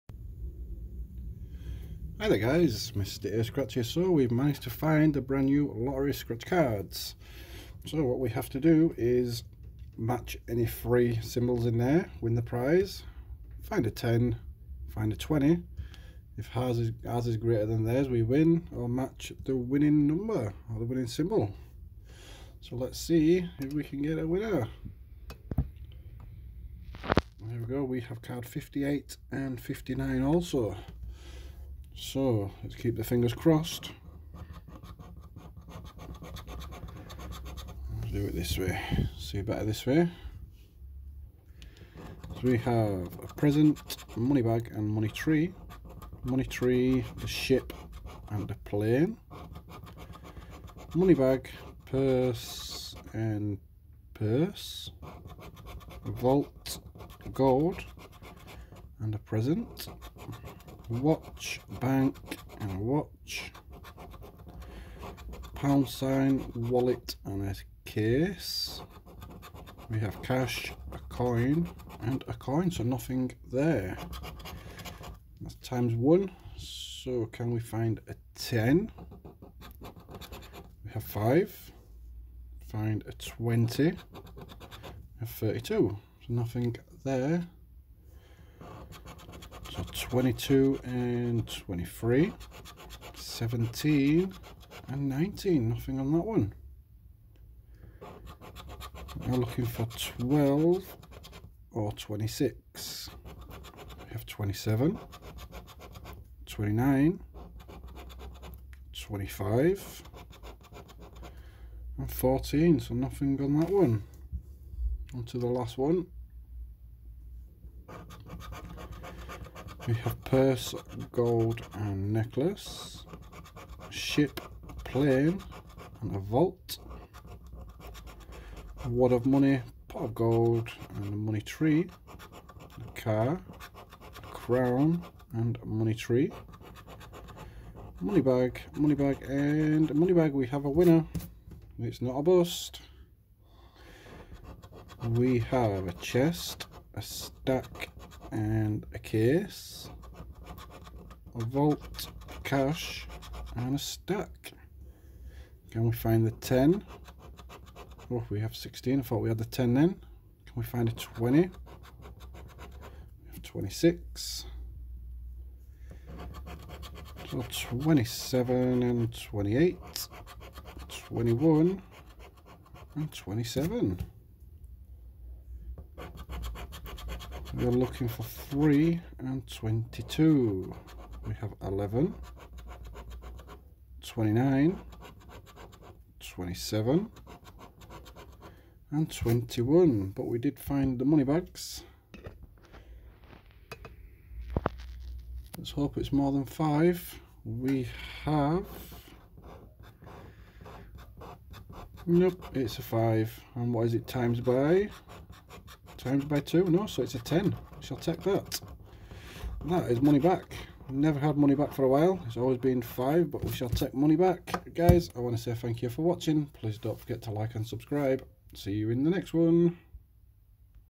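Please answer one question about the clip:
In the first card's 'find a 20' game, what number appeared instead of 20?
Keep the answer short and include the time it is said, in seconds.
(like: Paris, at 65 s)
32, at 85 s.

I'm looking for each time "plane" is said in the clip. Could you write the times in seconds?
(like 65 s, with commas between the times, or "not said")
48 s, 124 s.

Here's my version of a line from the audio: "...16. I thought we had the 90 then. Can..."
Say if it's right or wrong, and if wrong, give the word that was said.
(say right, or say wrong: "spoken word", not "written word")
wrong: "10", not "90".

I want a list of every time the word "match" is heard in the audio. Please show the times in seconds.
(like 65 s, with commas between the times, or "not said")
9 s, 18 s.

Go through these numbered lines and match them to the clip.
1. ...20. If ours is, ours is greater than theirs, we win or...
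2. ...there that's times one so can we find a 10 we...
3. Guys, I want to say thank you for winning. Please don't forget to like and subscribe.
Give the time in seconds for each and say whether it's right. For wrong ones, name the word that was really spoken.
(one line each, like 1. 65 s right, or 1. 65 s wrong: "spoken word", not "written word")
1. 15 s right
2. 73 s right
3. 214 s wrong: "watching", not "winning".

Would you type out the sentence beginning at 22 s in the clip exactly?
So let's see if we can get a winner.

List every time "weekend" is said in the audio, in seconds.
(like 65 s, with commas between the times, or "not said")
not said.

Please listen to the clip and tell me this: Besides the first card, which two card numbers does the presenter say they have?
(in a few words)
58 and 59.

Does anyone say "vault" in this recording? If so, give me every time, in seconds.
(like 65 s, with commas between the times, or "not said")
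56 s, 126 s, 151 s.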